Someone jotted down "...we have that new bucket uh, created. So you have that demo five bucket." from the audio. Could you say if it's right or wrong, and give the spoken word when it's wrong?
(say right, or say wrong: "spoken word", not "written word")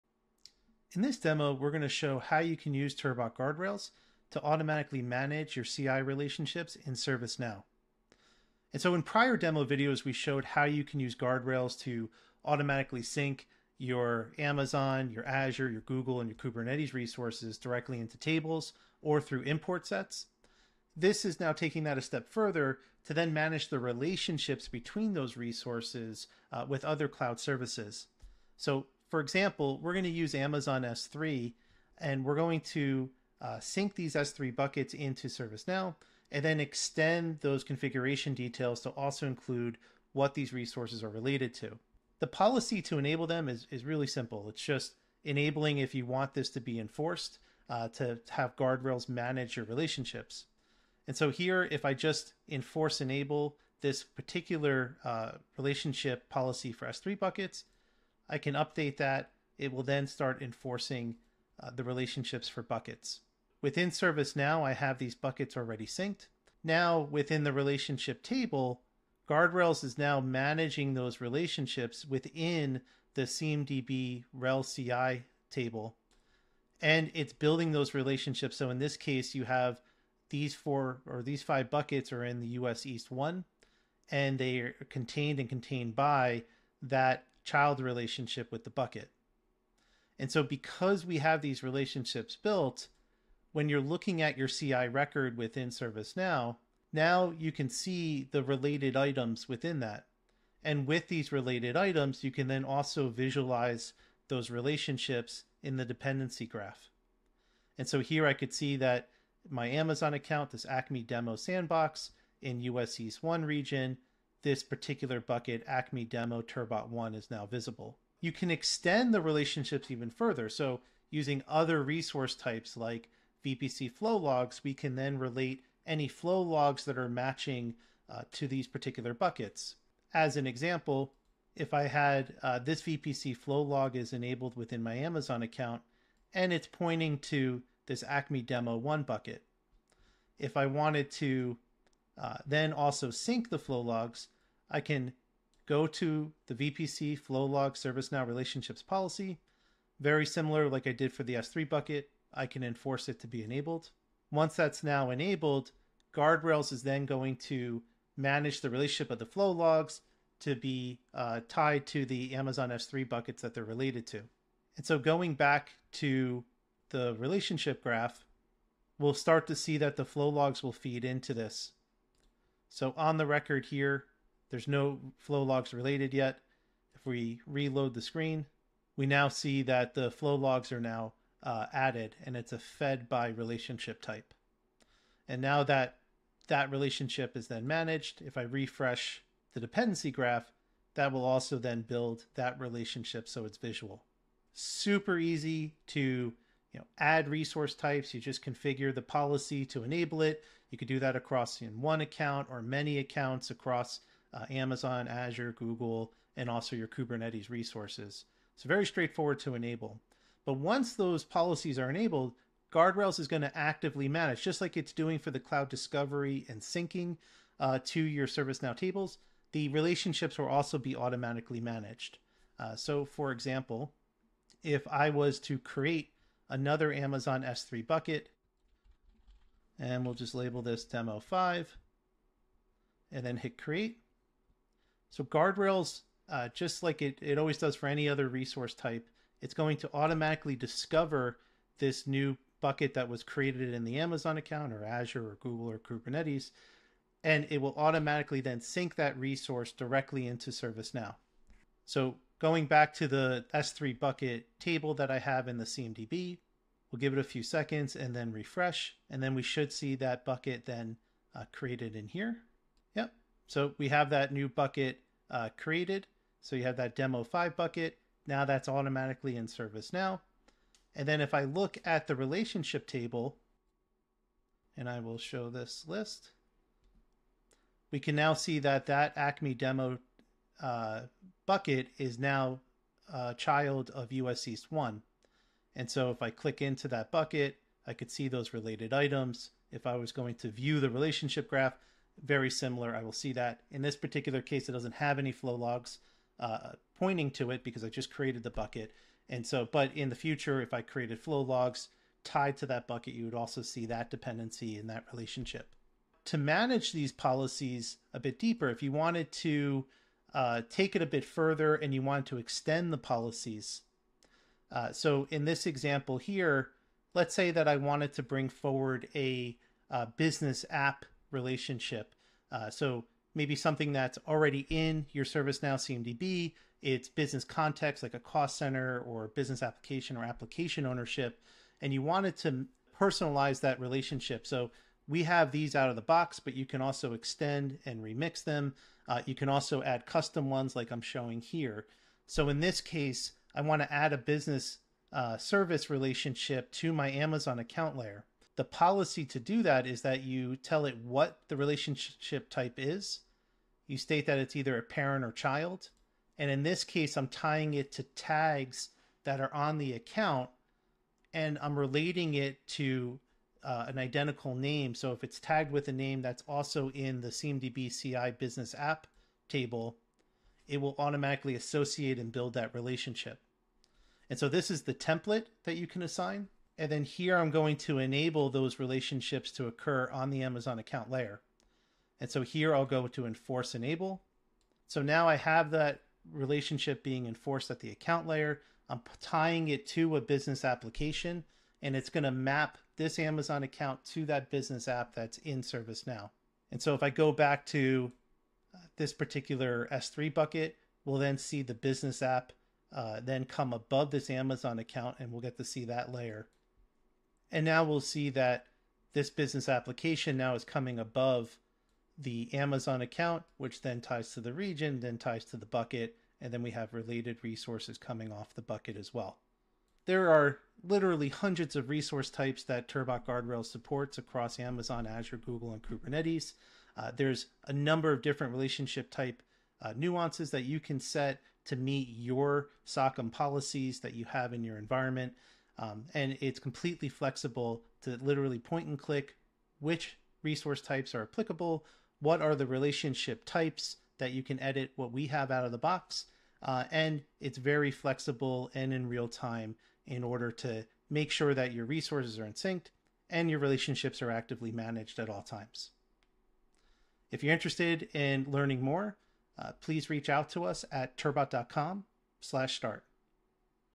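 right.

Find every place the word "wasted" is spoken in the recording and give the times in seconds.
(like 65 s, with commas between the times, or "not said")
not said.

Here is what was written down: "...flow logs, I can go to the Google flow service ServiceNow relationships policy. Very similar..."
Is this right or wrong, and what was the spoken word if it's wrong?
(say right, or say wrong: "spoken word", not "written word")
wrong: "VPC", not "Google".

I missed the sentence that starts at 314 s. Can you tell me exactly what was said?
Uh, so in this example here, let's say that I wanted to bring forward a, a uh, business app relationship.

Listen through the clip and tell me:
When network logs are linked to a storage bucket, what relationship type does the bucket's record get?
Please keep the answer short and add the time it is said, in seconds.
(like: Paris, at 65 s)
fed by, at 182 s.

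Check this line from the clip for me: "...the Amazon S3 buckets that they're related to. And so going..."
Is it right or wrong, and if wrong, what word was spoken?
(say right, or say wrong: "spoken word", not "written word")
right.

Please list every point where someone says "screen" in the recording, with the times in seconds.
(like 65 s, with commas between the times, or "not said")
178 s.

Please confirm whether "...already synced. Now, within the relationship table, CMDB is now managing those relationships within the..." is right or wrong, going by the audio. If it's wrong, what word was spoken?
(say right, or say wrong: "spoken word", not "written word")
wrong: "Guardrails", not "CMDB".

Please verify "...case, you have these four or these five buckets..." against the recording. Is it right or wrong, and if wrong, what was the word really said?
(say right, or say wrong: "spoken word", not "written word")
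right.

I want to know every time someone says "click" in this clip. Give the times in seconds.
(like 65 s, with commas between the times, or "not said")
286 s, 438 s.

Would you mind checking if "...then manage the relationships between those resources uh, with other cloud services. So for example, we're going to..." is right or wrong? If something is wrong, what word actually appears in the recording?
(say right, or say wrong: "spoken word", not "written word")
right.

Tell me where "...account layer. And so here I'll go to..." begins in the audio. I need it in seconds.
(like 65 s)
380 s.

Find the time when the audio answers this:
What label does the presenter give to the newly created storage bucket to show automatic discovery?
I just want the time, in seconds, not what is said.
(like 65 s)
230 s.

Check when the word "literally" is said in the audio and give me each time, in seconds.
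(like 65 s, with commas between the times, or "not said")
420 s, 438 s.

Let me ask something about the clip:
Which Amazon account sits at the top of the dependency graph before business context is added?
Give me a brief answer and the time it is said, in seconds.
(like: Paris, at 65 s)
Acme demo sandbox, at 110 s.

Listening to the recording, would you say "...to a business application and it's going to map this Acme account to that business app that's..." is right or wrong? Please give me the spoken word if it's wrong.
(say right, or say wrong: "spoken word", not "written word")
wrong: "Amazon", not "Acme".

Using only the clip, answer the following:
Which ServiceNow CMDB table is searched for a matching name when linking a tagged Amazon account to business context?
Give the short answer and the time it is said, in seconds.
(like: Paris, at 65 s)
CMDB CI business app, at 367 s.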